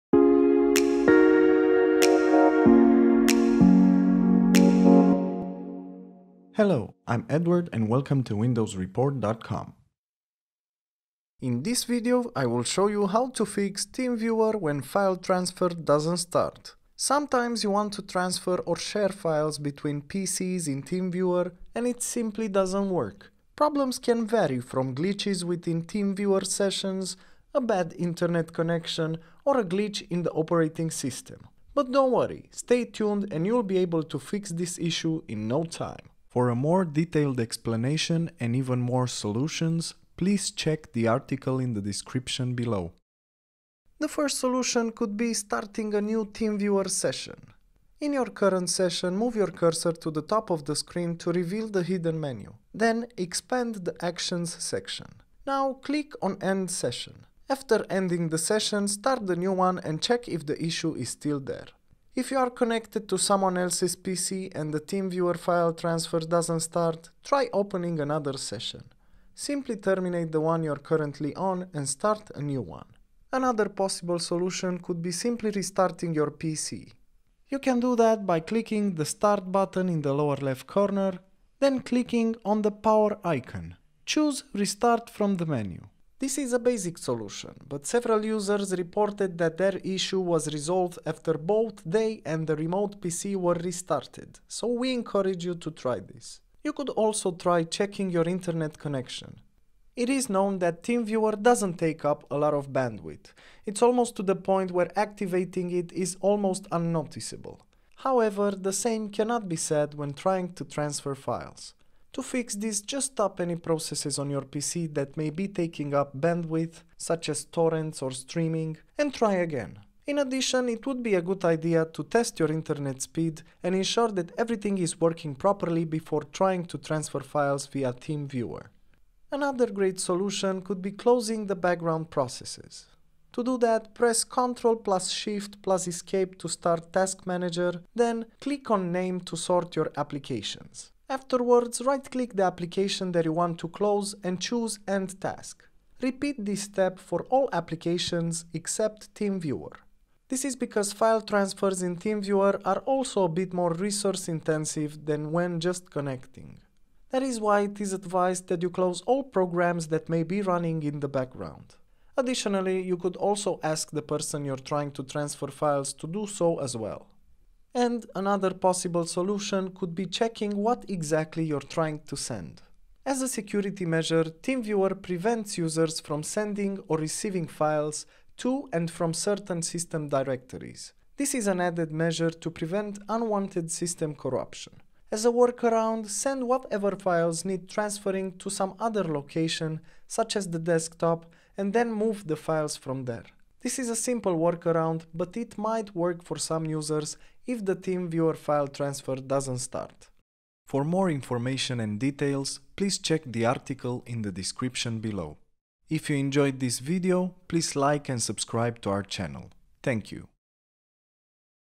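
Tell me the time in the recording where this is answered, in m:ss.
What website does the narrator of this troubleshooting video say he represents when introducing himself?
0:08.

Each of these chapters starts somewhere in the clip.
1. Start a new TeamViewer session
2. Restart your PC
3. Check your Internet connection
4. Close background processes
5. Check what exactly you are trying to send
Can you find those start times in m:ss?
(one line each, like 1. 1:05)
1. 0:44
2. 1:14
3. 1:37
4. 2:09
5. 2:49.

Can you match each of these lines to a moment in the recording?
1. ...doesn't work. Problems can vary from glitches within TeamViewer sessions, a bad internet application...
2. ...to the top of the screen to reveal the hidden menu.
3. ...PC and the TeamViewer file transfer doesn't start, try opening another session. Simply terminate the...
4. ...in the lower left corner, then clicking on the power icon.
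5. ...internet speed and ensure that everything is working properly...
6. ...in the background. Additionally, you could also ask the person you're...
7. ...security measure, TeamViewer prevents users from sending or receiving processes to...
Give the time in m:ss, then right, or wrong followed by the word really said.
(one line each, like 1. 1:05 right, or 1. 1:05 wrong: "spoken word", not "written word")
1. 0:22 wrong: "connection", not "application"
2. 0:49 right
3. 1:03 right
4. 1:19 right
5. 2:02 right
6. 2:40 right
7. 2:53 wrong: "files", not "processes".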